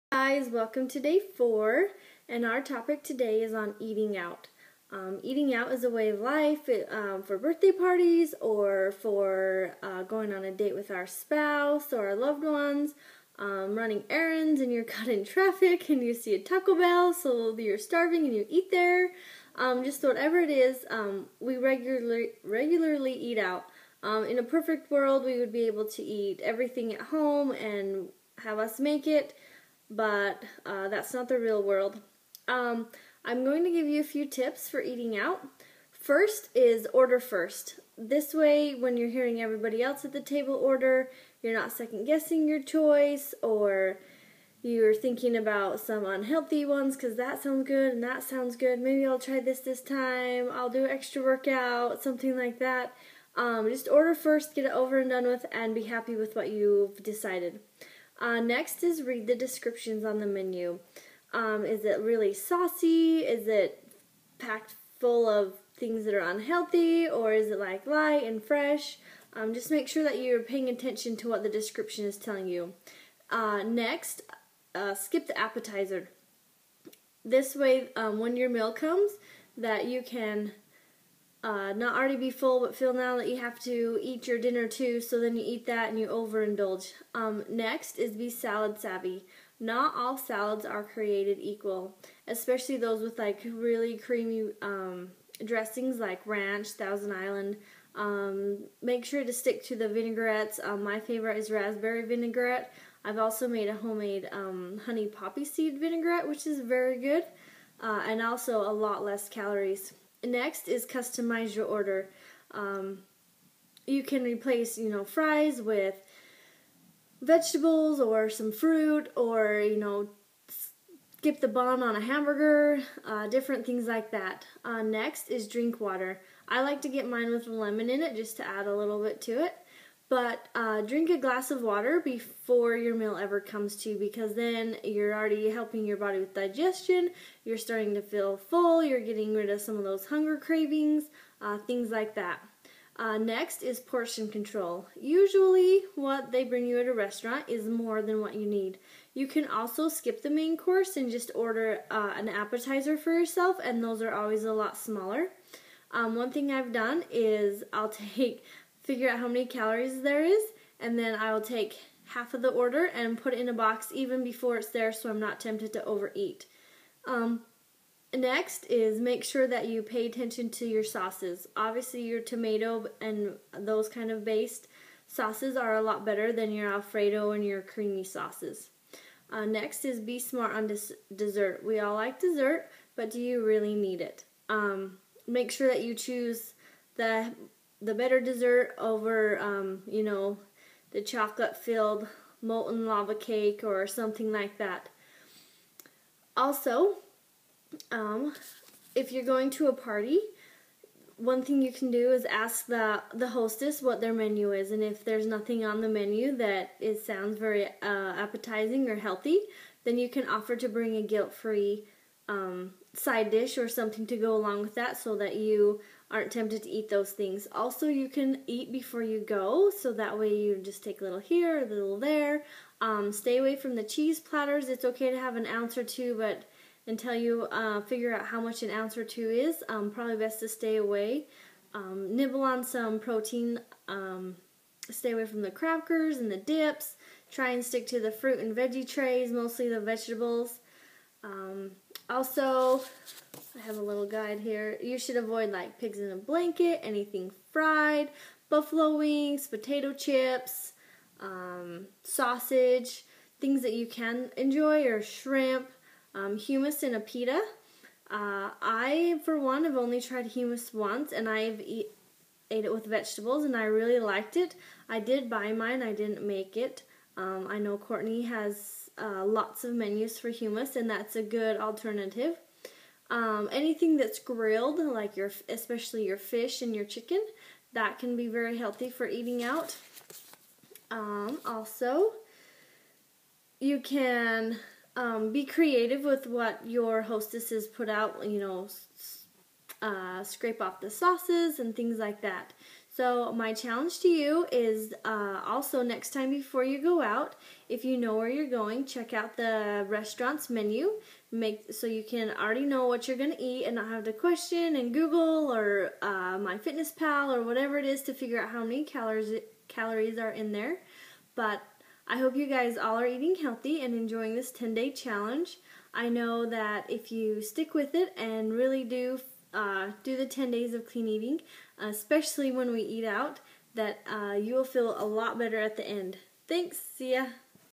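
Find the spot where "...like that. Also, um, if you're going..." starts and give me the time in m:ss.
3:14.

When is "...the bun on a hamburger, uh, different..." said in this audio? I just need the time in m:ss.
2:01.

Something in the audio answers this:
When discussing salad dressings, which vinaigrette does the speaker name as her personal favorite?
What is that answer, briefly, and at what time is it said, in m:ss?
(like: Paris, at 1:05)
Raspberry vinaigrette, at 1:41.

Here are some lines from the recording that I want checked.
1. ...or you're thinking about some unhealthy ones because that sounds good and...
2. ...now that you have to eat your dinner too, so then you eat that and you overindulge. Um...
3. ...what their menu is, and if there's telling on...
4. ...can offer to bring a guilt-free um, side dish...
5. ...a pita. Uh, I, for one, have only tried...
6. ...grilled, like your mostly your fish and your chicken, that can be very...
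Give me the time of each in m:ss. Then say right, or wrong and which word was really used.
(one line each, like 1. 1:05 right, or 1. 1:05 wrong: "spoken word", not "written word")
1. 0:43 right
2. 1:22 right
3. 3:23 wrong: "nothing", not "telling"
4. 3:30 right
5. 4:16 right
6. 4:34 wrong: "especially", not "mostly".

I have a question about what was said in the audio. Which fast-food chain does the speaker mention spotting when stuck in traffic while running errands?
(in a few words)
Taco Bell.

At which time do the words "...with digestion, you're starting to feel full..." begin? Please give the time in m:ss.
2:16.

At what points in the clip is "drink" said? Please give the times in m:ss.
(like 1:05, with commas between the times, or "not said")
2:05, 2:10.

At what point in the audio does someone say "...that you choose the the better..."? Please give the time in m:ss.
3:05.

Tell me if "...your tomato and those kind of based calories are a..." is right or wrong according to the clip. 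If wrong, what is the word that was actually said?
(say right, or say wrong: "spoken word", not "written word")
wrong: "sauces", not "calories".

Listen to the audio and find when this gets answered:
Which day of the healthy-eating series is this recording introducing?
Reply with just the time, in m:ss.
0:00.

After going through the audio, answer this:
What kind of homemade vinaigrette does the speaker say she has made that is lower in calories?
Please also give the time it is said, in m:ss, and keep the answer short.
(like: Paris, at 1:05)
Honey poppy seed, at 1:44.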